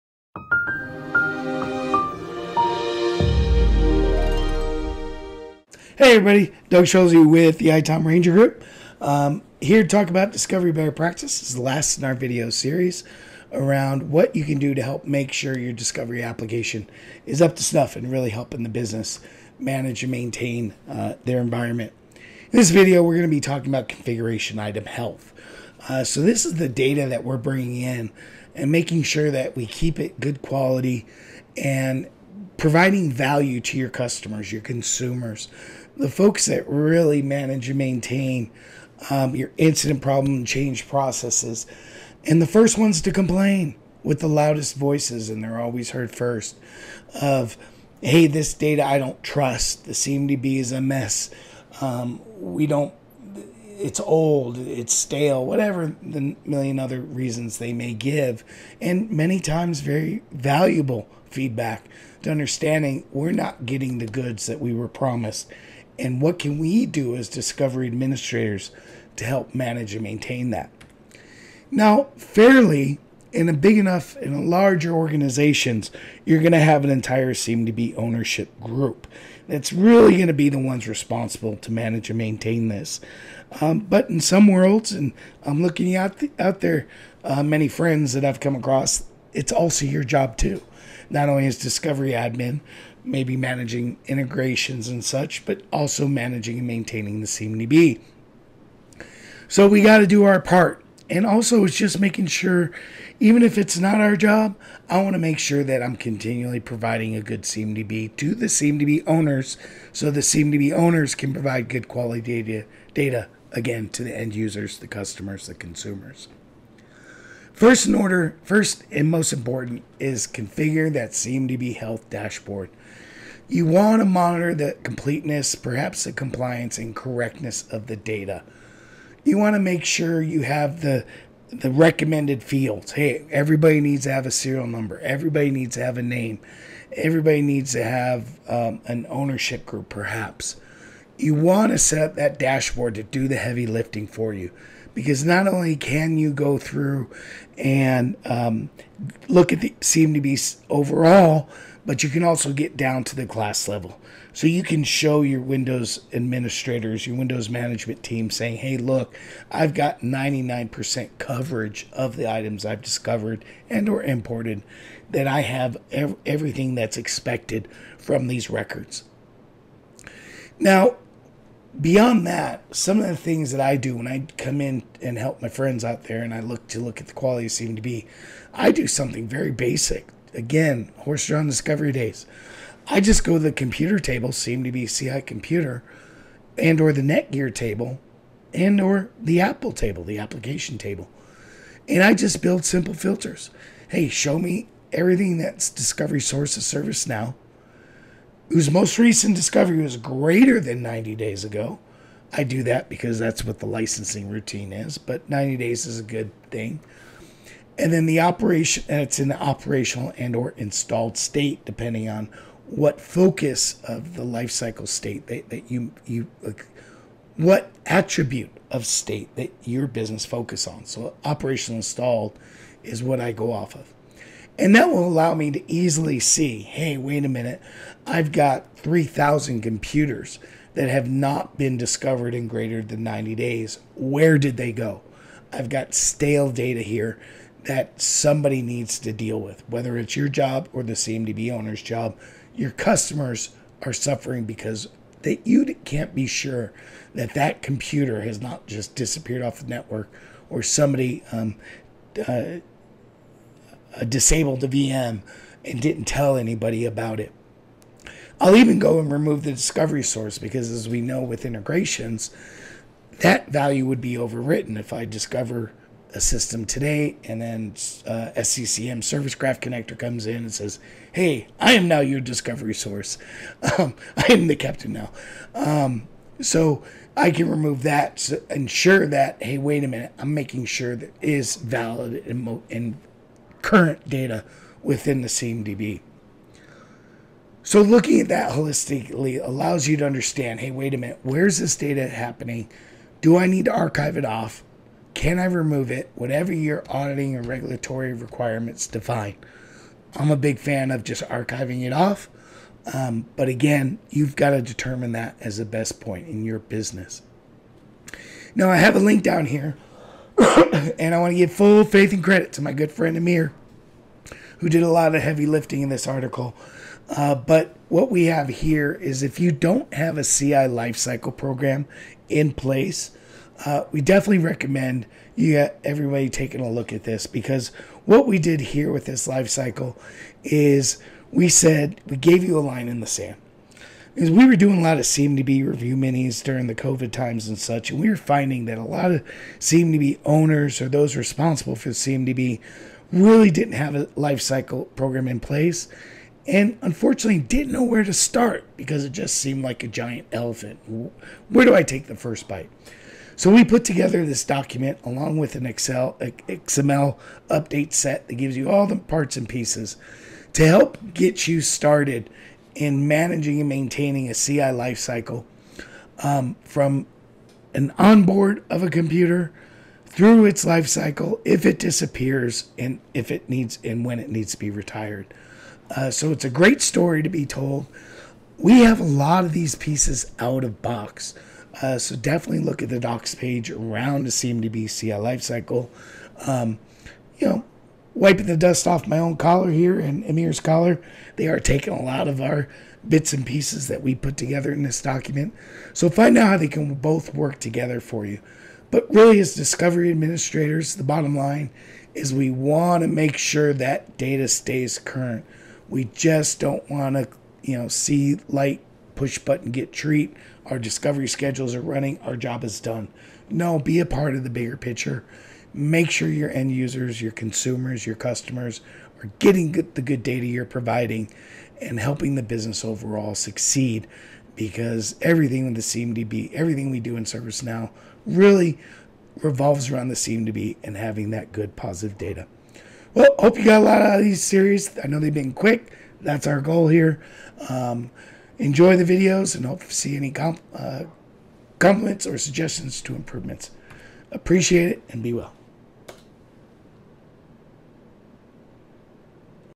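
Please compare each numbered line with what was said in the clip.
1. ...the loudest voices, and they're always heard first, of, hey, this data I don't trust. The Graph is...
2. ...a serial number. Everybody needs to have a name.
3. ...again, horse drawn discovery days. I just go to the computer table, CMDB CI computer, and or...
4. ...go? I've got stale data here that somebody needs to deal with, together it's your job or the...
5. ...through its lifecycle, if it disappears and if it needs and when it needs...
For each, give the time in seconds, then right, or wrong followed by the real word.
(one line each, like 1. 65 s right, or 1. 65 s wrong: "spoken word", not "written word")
1. 44 s wrong: "CMDB", not "Graph"
2. 134 s right
3. 180 s right
4. 234 s wrong: "whether", not "together"
5. 370 s right.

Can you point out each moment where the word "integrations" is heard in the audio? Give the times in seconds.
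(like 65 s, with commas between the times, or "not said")
94 s, 261 s.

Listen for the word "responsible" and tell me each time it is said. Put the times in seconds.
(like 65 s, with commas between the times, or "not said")
80 s, 341 s.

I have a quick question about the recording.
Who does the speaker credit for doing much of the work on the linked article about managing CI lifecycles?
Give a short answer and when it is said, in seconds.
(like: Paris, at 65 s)
Amir, at 313 s.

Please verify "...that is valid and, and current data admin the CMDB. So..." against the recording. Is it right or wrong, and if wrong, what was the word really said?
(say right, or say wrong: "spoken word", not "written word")
wrong: "within", not "admin".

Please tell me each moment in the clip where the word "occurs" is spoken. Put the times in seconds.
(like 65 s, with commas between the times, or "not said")
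not said.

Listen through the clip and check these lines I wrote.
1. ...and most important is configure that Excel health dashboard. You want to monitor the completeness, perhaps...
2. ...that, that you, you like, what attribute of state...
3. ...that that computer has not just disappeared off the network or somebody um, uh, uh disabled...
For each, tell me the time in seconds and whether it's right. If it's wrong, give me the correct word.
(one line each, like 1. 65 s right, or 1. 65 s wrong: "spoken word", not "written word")
1. 118 s wrong: "CMDB", not "Excel"
2. 215 s right
3. 247 s right.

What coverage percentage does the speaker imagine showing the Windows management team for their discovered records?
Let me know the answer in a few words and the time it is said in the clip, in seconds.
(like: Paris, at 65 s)
99%, at 160 s.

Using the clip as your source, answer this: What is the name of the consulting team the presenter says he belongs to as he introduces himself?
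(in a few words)
ITOM Ranger Group.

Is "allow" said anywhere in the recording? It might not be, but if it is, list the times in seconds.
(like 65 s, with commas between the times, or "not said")
225 s, 289 s.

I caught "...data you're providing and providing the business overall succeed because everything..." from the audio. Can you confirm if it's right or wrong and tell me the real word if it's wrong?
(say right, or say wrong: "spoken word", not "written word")
wrong: "helping", not "providing".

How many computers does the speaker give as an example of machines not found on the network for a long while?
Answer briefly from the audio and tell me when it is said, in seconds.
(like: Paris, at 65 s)
3,000, at 228 s.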